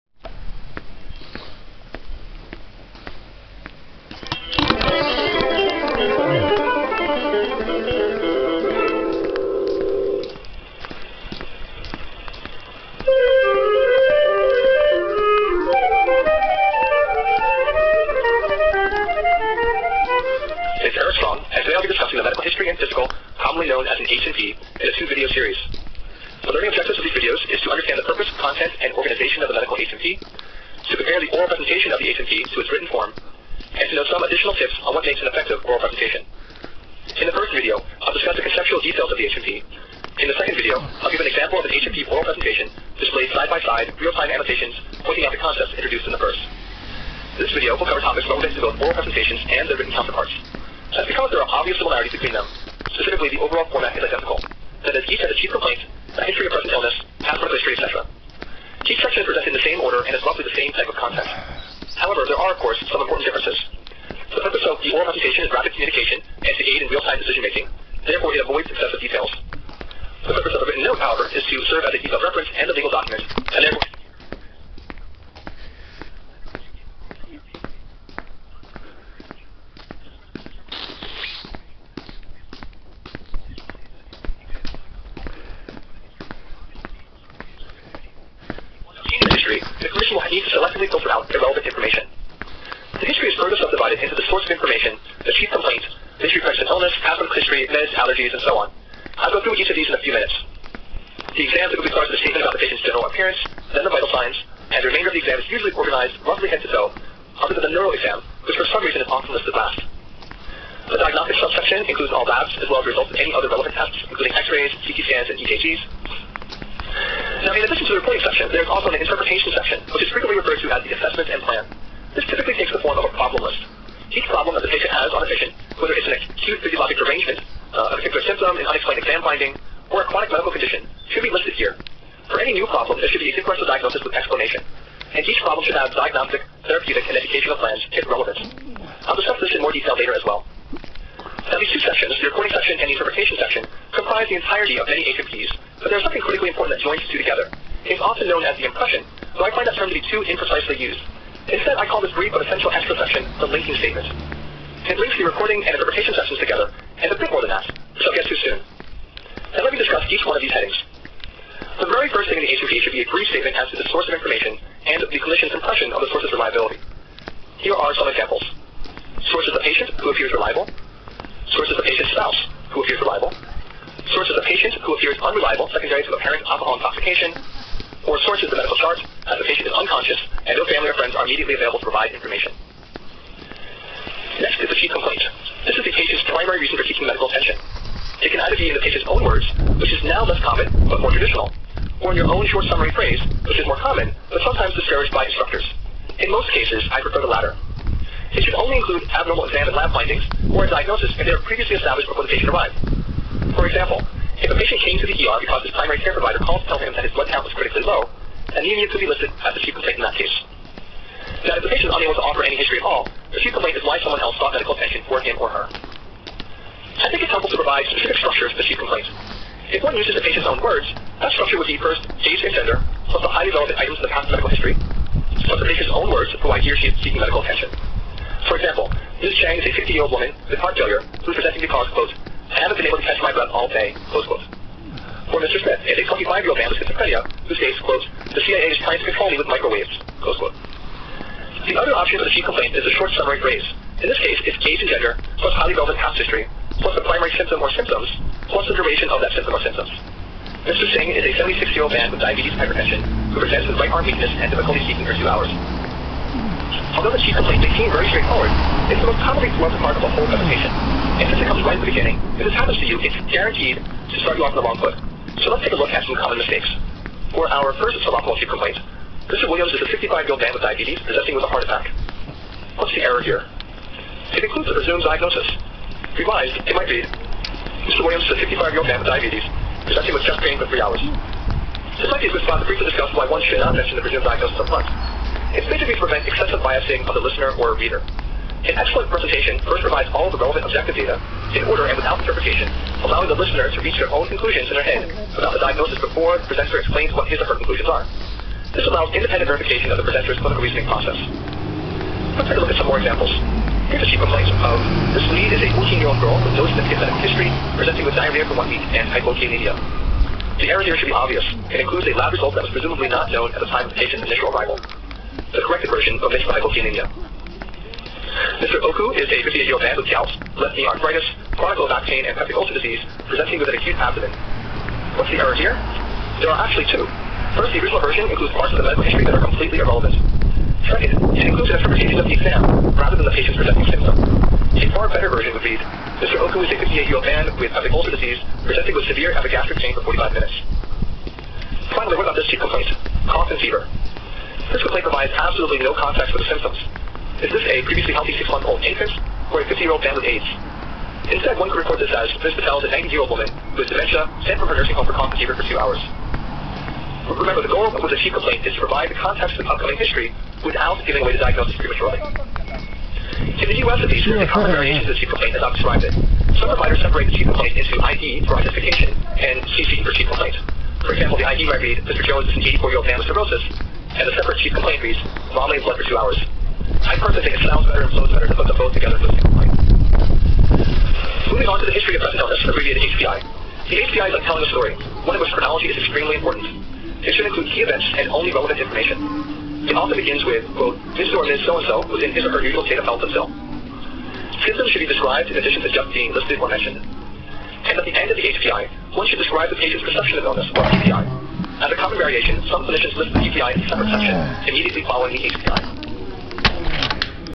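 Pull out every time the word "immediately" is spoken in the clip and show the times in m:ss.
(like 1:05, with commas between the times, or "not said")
3:01, 6:44.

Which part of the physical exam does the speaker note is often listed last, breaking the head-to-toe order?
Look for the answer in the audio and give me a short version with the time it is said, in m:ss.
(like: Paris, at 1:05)
neuro exam, at 1:47.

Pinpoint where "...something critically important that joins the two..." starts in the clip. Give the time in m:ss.
2:26.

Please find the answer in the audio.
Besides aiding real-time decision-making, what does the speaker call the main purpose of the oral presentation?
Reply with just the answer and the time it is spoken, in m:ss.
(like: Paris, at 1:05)
rapid communication, at 1:05.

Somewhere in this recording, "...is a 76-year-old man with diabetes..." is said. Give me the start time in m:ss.
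4:11.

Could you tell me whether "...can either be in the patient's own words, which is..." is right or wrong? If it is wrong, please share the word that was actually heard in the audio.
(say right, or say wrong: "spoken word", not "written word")
right.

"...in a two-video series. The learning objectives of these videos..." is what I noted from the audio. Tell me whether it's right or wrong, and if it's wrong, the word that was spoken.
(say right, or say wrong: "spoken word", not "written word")
right.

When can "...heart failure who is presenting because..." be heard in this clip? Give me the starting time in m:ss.
3:50.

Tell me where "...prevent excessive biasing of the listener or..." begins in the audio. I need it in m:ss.
4:45.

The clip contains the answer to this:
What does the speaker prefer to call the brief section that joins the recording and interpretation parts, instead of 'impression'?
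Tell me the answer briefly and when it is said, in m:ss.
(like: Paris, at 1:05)
linking statement, at 2:33.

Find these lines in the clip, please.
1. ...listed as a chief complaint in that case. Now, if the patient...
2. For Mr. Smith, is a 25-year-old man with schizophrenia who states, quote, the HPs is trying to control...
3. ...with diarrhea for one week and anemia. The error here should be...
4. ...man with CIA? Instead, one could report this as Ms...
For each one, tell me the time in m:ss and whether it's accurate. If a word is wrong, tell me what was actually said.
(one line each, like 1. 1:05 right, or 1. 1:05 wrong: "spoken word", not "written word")
1. 3:29 right
2. 3:55 wrong: "CIA", not "HPs"
3. 5:08 wrong: "hypokalemia", not "anemia"
4. 5:50 wrong: "AIDS", not "CIA".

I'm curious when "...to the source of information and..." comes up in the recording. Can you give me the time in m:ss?
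2:43.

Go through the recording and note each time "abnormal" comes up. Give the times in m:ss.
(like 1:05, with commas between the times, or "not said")
3:19.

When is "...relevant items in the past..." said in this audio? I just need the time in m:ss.
3:43.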